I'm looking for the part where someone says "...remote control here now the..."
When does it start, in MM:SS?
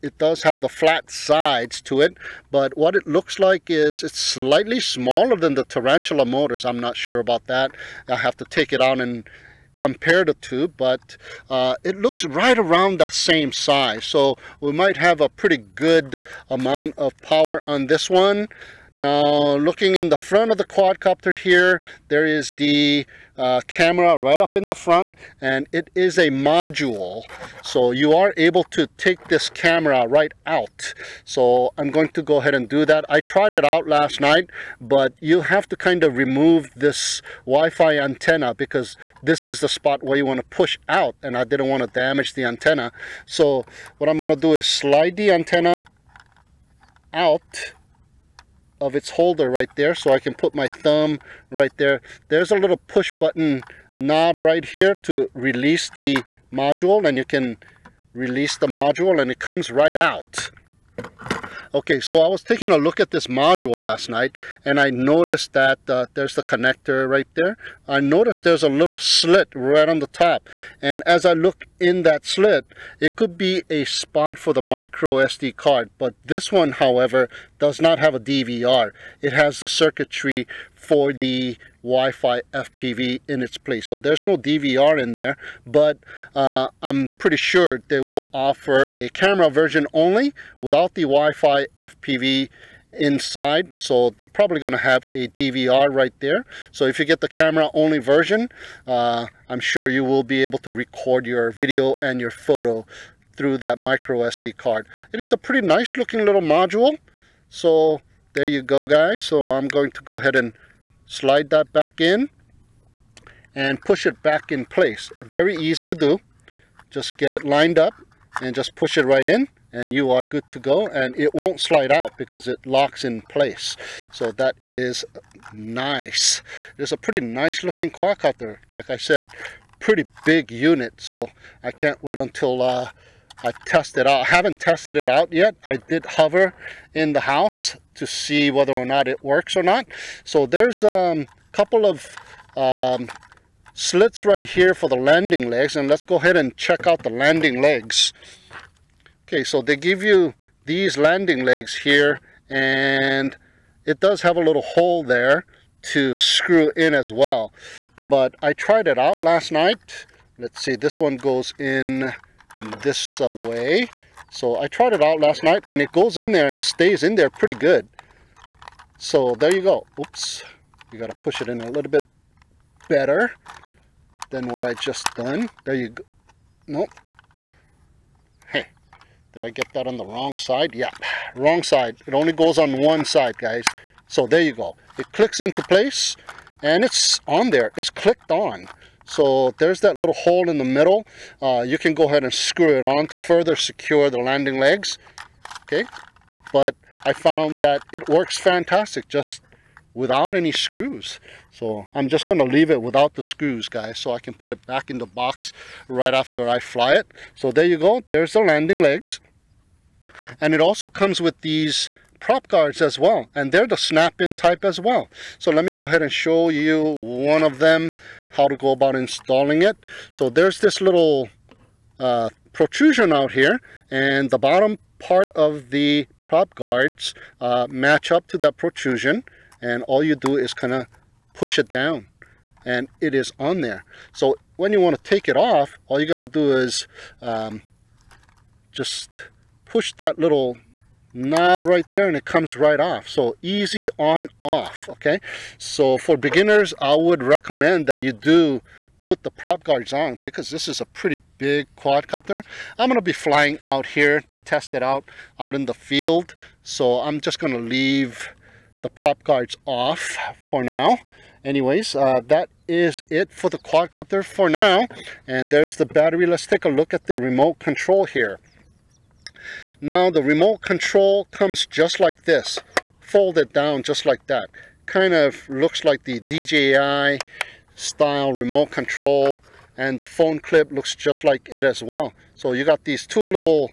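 04:27.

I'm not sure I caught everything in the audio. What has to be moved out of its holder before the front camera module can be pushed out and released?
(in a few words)
Wi-Fi antenna.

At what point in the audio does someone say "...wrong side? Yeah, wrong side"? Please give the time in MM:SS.
03:00.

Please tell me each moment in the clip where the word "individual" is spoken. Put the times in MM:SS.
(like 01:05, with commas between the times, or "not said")
not said.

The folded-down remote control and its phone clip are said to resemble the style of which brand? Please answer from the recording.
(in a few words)
DJI.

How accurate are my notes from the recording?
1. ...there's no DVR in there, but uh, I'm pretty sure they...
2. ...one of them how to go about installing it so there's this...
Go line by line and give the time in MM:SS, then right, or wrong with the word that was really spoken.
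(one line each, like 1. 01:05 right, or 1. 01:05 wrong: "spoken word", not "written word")
1. 01:23 right
2. 03:36 right.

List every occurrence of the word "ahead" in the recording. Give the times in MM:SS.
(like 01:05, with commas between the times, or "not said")
00:32, 01:50, 02:26, 03:12, 03:35.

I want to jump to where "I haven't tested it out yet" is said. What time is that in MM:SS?
02:14.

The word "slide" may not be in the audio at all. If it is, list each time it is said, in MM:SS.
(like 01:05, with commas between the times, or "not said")
00:44, 01:51, 02:01.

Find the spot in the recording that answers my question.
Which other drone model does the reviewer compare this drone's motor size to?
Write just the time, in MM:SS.
00:05.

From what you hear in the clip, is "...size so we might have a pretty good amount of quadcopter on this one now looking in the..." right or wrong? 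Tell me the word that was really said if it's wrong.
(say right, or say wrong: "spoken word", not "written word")
wrong: "power", not "quadcopter".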